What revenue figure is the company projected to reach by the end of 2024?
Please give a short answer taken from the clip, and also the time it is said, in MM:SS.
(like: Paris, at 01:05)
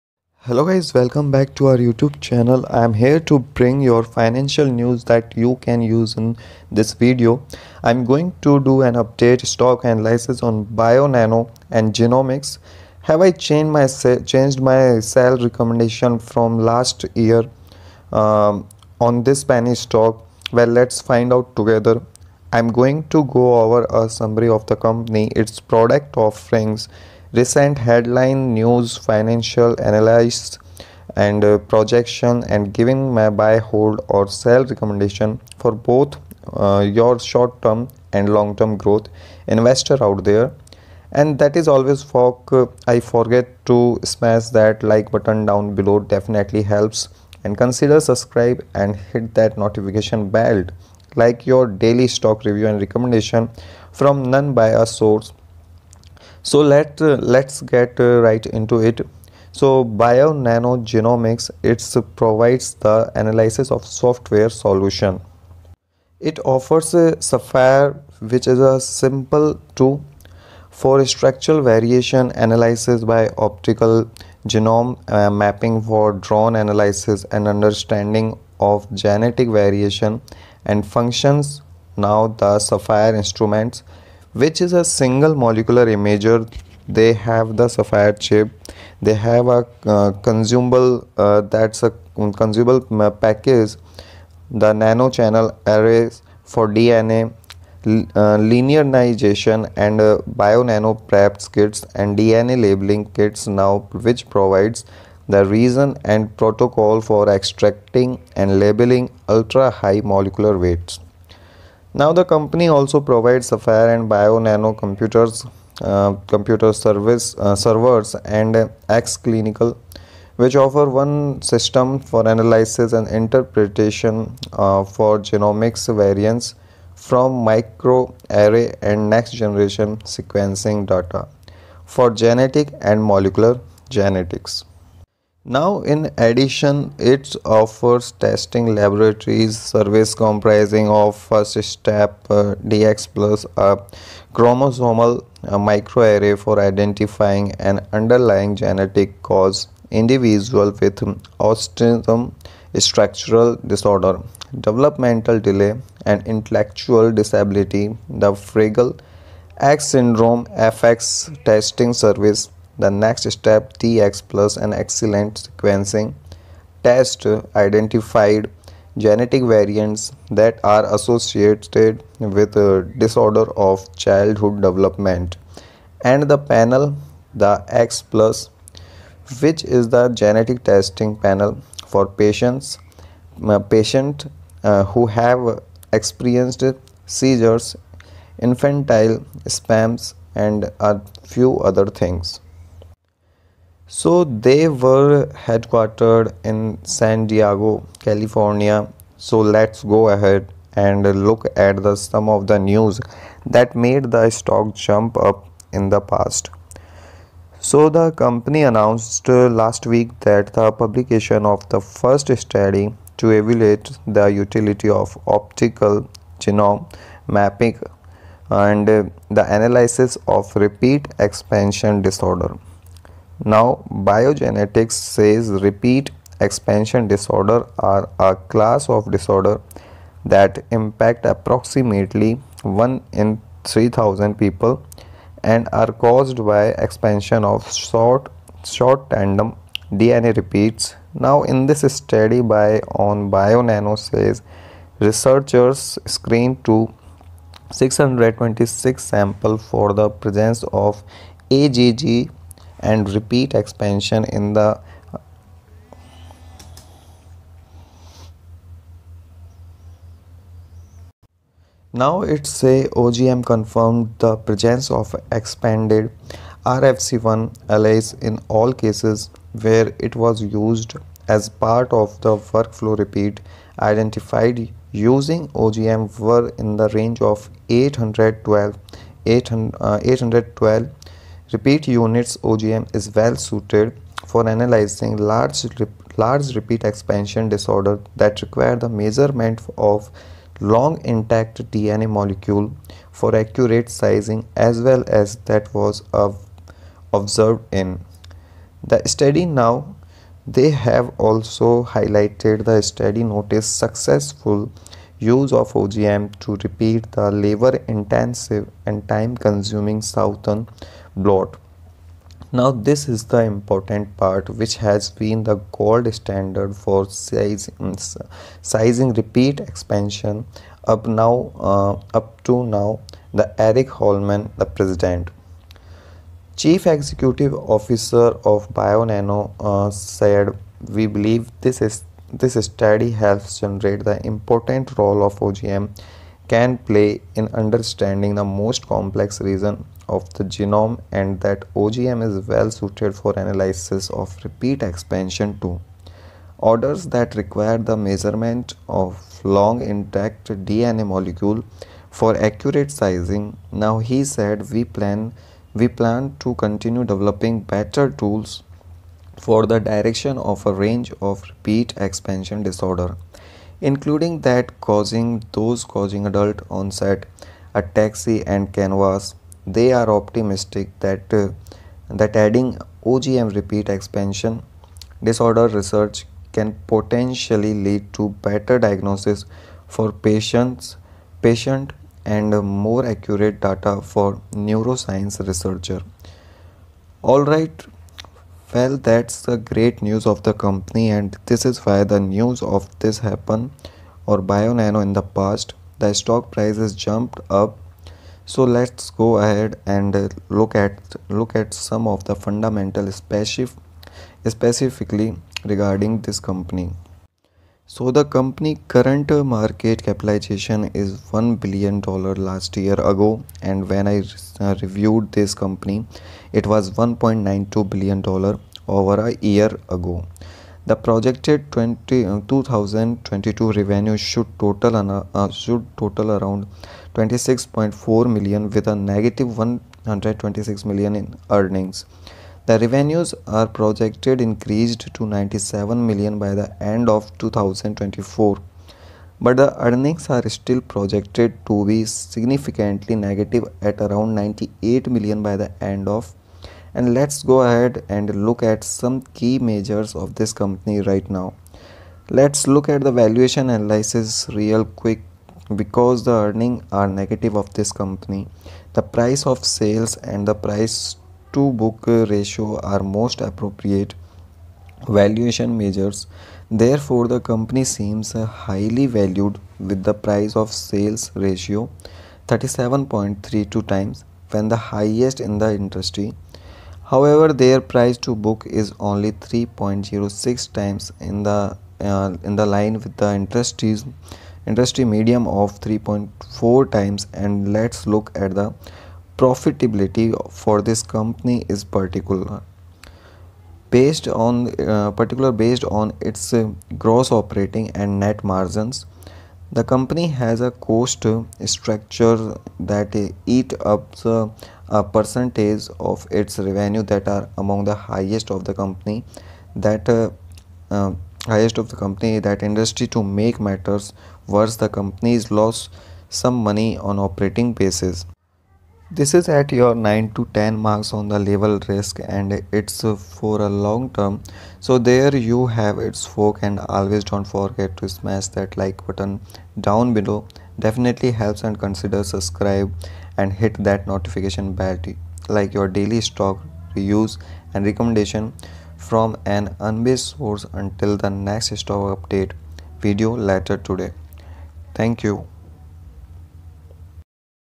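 97 million, at 07:15.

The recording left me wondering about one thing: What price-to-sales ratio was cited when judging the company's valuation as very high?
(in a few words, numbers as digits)
37.32.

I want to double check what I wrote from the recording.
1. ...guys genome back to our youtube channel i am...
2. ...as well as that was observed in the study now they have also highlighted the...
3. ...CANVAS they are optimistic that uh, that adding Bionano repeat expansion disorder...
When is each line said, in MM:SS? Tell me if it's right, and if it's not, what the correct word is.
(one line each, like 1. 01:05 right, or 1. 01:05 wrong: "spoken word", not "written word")
1. 00:00 wrong: "welcome", not "genome"
2. 04:54 right
3. 06:08 wrong: "OGM", not "Bionano".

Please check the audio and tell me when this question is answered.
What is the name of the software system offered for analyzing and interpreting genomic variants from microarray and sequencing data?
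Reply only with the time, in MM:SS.
01:58.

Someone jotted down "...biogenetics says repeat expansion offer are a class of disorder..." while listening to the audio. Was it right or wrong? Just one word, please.
wrong.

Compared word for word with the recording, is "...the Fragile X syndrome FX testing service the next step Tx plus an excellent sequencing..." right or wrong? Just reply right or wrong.
right.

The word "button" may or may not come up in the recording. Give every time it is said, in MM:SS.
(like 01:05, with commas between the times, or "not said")
00:45, 08:49.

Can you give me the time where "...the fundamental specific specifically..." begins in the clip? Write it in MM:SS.
06:42.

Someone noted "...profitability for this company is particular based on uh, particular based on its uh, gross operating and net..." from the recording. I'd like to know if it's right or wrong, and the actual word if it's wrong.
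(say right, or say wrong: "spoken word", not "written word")
right.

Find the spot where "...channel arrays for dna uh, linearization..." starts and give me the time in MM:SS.
01:35.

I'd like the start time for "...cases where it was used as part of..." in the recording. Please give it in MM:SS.
04:28.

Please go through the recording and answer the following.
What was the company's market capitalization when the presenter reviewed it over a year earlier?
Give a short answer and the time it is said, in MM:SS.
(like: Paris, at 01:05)
$1.92 billion, at 06:56.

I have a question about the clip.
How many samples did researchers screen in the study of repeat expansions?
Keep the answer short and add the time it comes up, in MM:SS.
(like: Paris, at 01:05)
626, at 04:07.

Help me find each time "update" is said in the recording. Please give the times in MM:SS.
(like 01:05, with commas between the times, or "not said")
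00:08, 09:02.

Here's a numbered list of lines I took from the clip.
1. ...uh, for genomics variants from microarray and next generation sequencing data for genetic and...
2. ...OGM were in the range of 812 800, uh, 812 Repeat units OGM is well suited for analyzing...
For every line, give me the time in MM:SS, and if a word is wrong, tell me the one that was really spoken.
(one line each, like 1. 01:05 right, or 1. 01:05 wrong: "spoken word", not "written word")
1. 02:04 right
2. 04:35 right.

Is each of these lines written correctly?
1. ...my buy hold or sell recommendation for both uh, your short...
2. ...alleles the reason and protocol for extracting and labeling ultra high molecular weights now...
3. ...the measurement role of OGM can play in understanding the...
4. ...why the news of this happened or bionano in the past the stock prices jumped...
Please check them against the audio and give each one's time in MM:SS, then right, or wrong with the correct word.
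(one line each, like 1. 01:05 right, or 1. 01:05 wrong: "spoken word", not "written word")
1. 00:33 right
2. 01:44 wrong: "provides", not "alleles"
3. 05:34 wrong: "important", not "measurement"
4. 06:31 right.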